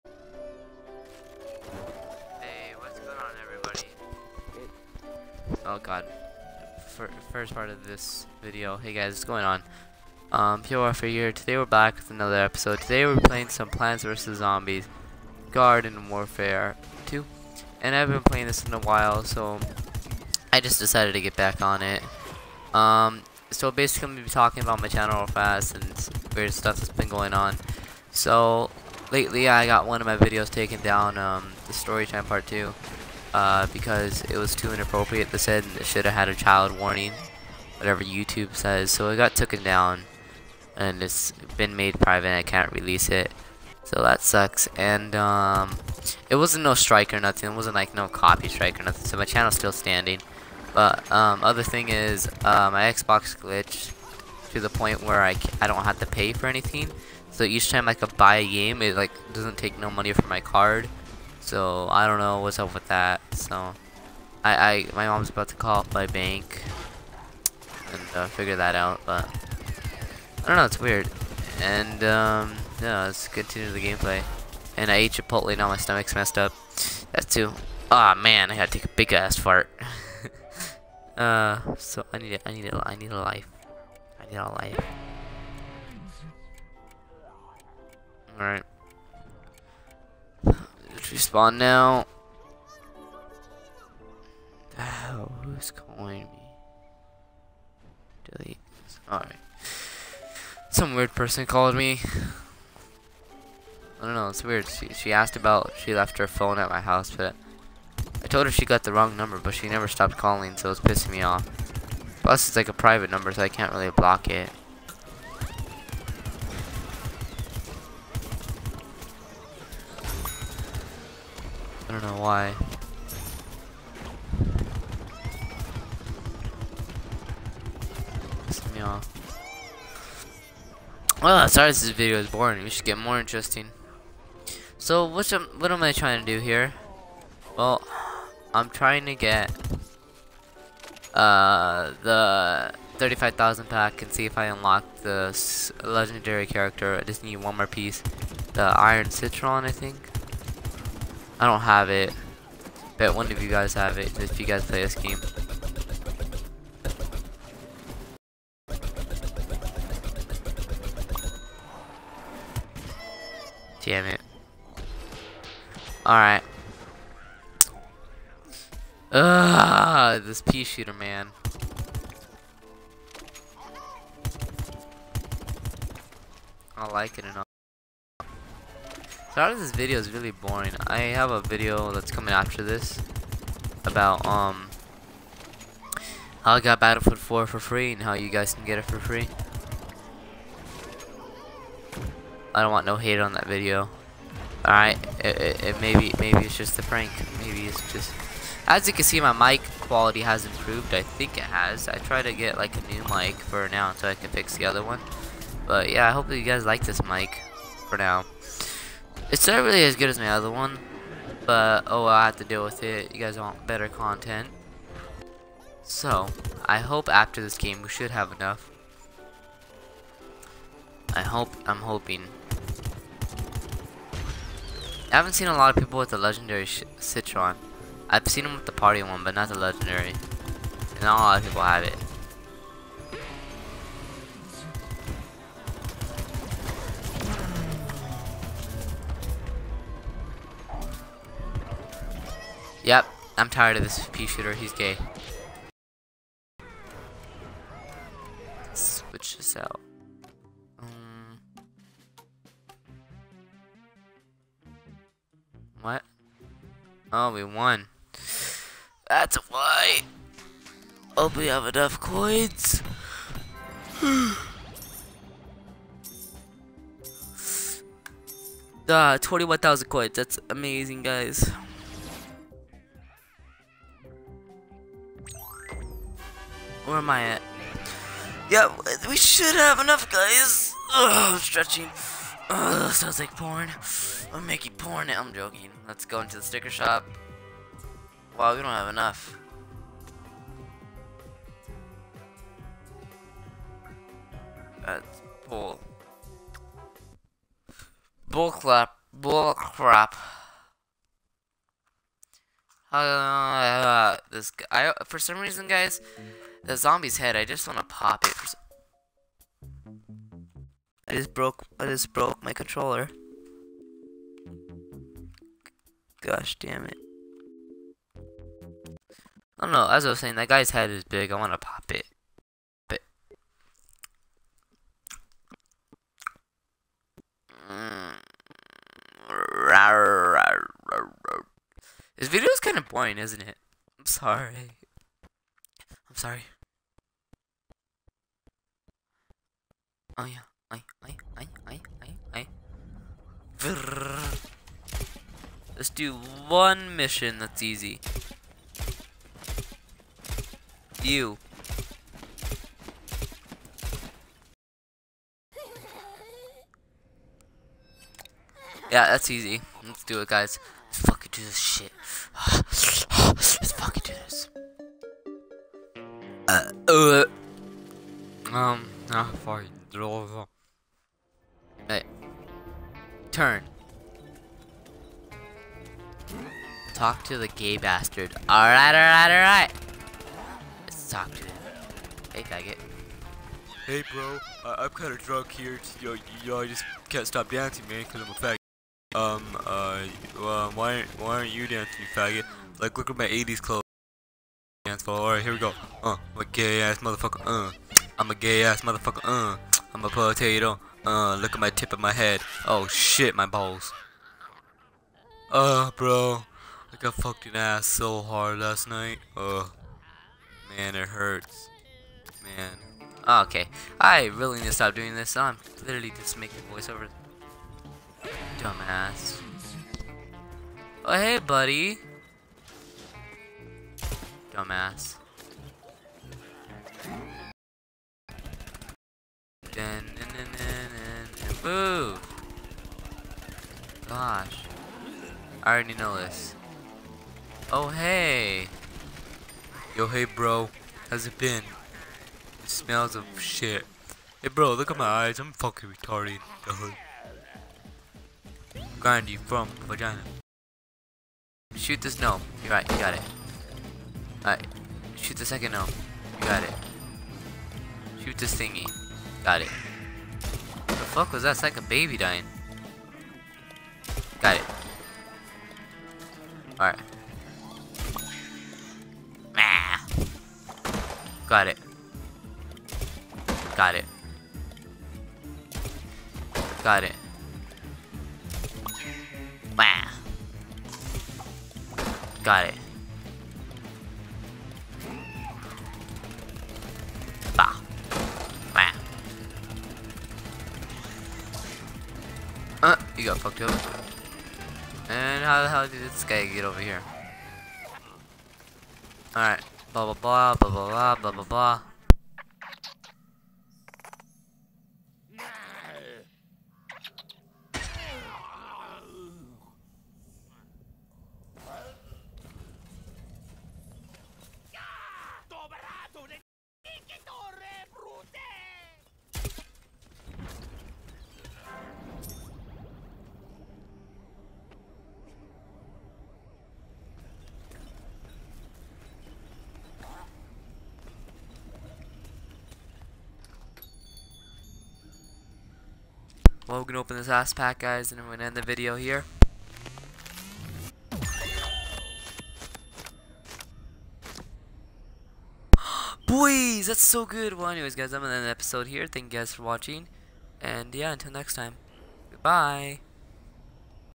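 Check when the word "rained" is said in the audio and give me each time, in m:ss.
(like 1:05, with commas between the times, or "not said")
not said.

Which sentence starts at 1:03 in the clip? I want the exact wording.
So I, I my mom's about to call up my bank and uh, figure that out.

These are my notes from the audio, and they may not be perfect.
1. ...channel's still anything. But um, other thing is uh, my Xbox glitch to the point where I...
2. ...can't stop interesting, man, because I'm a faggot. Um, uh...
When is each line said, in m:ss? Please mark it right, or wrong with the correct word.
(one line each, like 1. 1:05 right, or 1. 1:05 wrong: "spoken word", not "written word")
1. 0:49 wrong: "standing", not "anything"
2. 6:27 wrong: "dancing", not "interesting".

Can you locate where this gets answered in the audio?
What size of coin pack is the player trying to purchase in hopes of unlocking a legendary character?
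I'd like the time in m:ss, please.
2:22.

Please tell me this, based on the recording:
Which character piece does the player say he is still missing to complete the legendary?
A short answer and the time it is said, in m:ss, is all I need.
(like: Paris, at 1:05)
Iron Citron, at 2:28.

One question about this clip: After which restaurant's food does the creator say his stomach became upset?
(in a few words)
Chipotle.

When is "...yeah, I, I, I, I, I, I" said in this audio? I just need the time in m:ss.
5:40.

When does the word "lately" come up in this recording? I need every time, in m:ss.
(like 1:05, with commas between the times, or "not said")
0:29.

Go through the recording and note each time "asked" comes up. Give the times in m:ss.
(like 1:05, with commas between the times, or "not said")
1:45.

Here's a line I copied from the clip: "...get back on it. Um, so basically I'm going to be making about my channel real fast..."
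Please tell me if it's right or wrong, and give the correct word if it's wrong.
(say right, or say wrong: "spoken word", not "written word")
wrong: "talking", not "making".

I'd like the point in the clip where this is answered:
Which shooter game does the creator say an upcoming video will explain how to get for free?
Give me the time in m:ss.
3:06.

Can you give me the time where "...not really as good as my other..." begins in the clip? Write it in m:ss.
3:29.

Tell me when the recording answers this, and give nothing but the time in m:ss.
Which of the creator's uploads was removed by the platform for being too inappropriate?
0:31.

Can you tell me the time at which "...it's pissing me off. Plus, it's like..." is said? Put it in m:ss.
1:50.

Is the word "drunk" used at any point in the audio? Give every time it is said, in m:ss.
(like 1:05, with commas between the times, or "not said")
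6:25.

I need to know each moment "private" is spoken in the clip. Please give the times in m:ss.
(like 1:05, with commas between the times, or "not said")
0:41, 1:52.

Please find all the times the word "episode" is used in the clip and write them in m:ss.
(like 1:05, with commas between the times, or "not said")
0:12, 9:08.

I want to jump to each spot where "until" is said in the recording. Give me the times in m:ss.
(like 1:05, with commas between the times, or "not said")
3:23, 9:11.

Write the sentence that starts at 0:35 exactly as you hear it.
They said it should have had a child warning, whatever YouTube says.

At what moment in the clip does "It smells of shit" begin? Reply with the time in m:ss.
7:22.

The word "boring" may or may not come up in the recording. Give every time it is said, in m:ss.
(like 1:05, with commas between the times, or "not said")
2:12, 3:00, 5:32.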